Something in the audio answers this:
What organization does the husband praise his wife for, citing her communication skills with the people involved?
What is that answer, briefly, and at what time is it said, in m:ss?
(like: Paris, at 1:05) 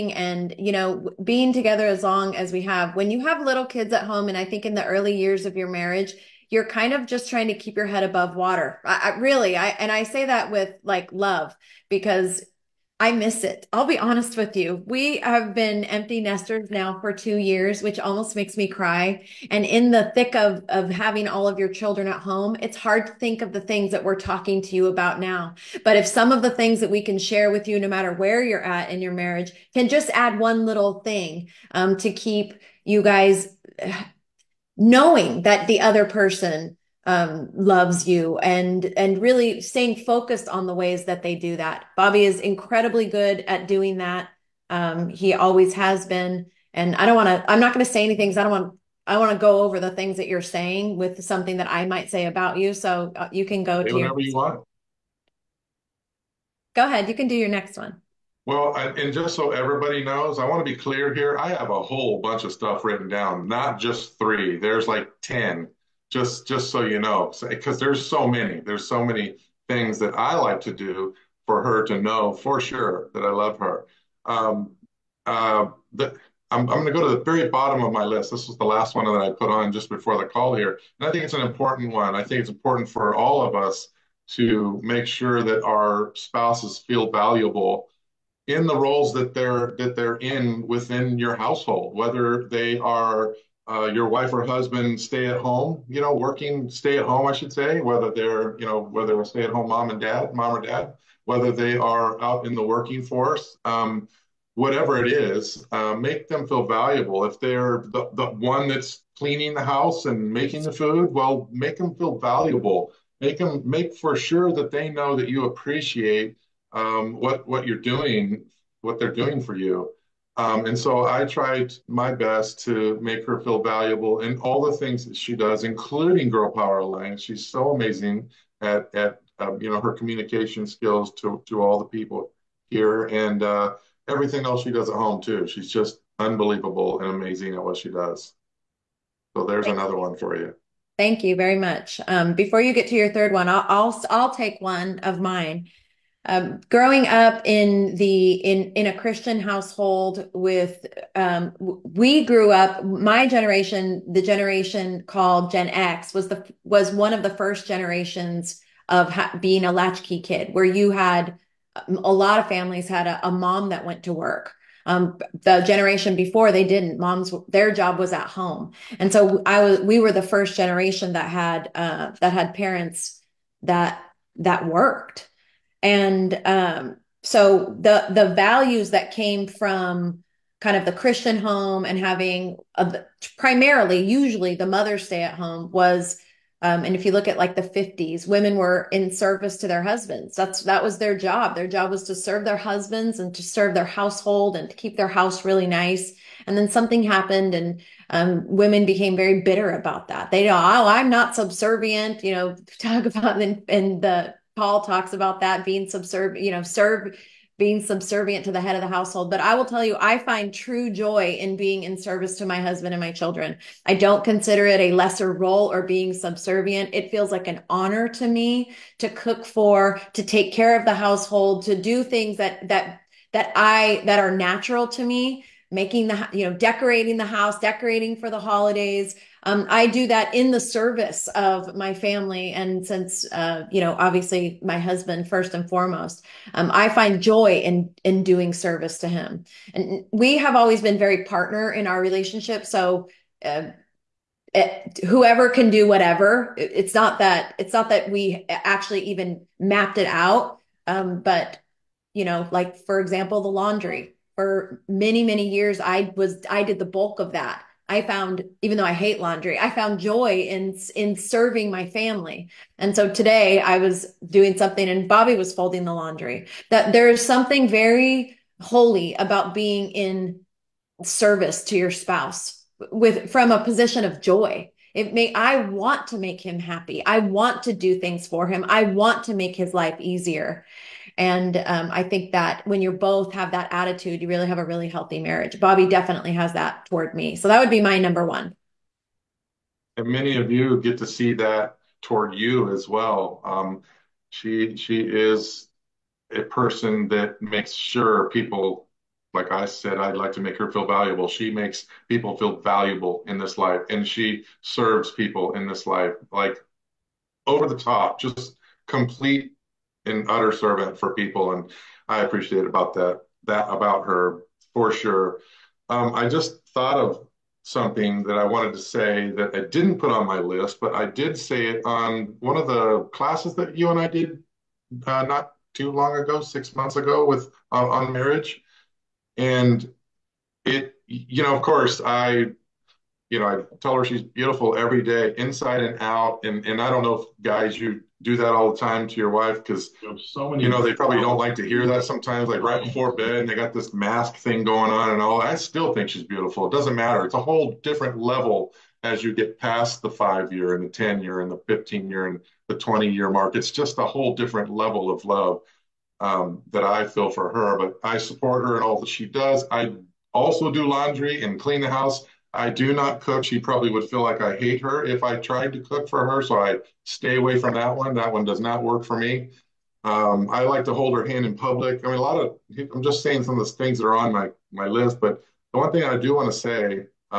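Girl Power Alliance, at 2:06.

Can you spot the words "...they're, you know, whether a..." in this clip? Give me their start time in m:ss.
1:38.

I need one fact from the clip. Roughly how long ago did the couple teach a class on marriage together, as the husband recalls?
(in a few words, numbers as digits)
6 months ago.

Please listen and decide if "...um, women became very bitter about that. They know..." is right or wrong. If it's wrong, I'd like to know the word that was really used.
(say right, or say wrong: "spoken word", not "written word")
right.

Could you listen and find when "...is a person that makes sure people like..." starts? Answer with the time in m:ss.
4:55.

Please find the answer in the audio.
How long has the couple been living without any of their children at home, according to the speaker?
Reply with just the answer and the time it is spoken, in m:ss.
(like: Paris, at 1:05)
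2 years, at 0:17.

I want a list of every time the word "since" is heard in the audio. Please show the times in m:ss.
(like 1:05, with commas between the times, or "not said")
3:52.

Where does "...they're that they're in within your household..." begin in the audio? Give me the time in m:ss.
1:29.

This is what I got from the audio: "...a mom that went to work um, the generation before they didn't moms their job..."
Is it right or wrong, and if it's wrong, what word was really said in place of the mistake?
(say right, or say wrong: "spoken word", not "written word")
right.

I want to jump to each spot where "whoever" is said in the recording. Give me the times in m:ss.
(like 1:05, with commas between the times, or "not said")
4:05.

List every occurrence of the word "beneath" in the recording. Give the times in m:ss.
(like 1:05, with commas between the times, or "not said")
not said.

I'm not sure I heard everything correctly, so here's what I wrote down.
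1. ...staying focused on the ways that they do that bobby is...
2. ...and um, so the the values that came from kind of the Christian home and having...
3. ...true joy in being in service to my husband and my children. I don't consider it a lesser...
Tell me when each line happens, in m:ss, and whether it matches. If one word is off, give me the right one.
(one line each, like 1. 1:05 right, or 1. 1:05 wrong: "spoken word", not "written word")
1. 0:39 right
2. 2:55 right
3. 3:30 right.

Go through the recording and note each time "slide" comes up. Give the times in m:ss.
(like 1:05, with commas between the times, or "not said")
not said.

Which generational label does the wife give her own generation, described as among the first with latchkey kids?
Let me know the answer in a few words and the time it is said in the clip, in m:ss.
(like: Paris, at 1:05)
Gen X, at 2:35.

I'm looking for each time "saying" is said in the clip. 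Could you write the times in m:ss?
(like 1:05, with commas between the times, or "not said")
0:50, 6:13.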